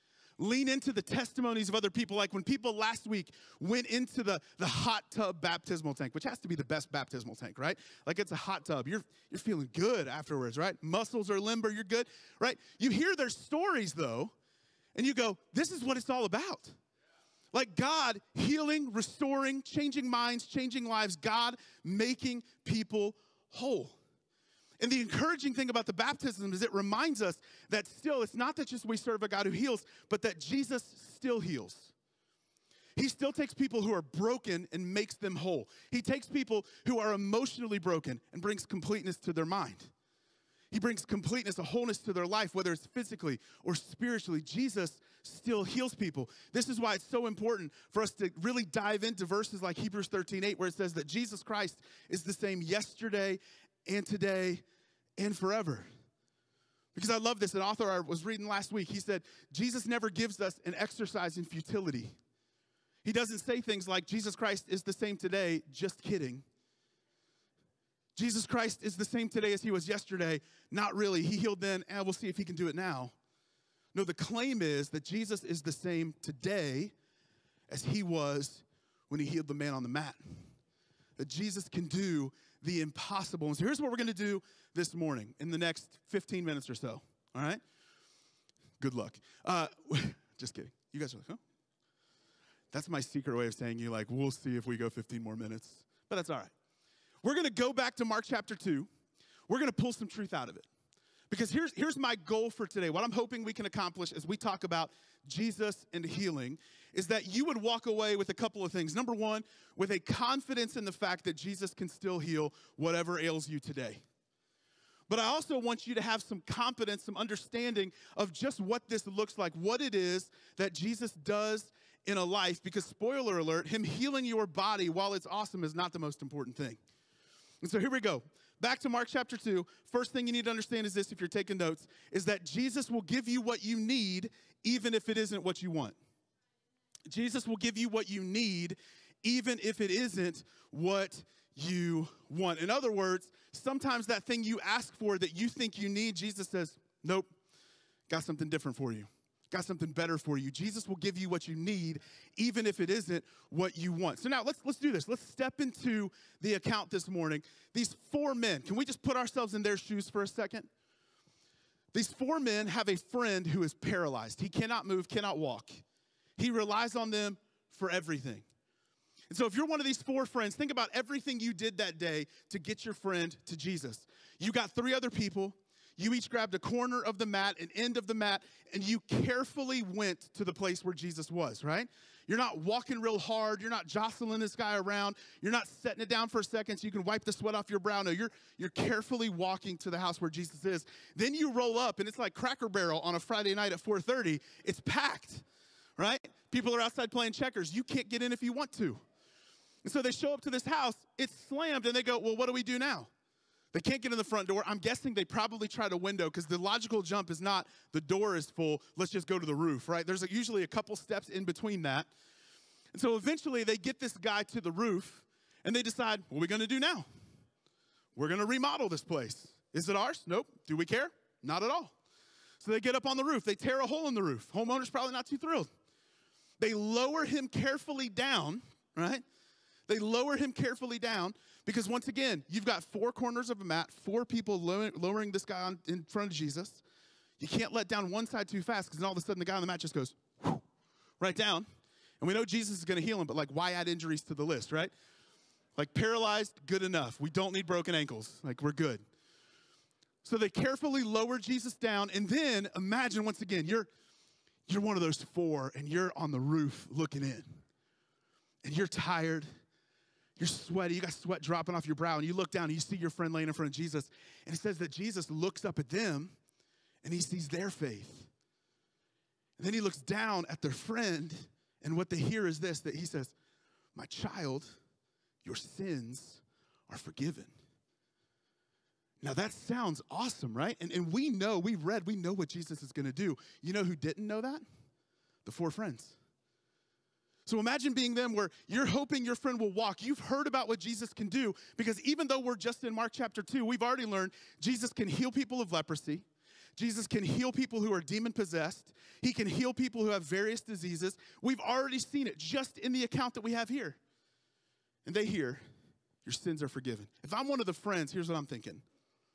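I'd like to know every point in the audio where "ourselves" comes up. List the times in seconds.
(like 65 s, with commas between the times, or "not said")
159 s.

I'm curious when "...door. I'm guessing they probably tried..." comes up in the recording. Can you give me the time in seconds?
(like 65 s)
204 s.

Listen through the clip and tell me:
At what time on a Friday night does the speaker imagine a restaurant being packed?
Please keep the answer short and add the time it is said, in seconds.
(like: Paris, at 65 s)
4:30, at 193 s.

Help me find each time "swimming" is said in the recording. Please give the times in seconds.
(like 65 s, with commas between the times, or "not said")
not said.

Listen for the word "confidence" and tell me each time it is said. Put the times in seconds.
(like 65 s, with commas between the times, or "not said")
109 s, 116 s.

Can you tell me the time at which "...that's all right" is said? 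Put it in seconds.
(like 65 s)
96 s.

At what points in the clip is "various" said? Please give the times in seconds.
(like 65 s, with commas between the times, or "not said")
300 s.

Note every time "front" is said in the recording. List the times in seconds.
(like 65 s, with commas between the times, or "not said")
204 s, 236 s, 263 s.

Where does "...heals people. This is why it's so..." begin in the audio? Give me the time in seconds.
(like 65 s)
45 s.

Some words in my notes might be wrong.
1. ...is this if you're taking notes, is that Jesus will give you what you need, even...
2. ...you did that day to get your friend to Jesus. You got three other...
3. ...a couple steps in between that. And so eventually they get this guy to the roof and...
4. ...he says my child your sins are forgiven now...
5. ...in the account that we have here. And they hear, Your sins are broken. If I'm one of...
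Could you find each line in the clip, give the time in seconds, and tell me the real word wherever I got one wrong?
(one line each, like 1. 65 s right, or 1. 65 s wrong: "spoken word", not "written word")
1. 130 s right
2. 171 s right
3. 210 s right
4. 272 s right
5. 302 s wrong: "forgiven", not "broken".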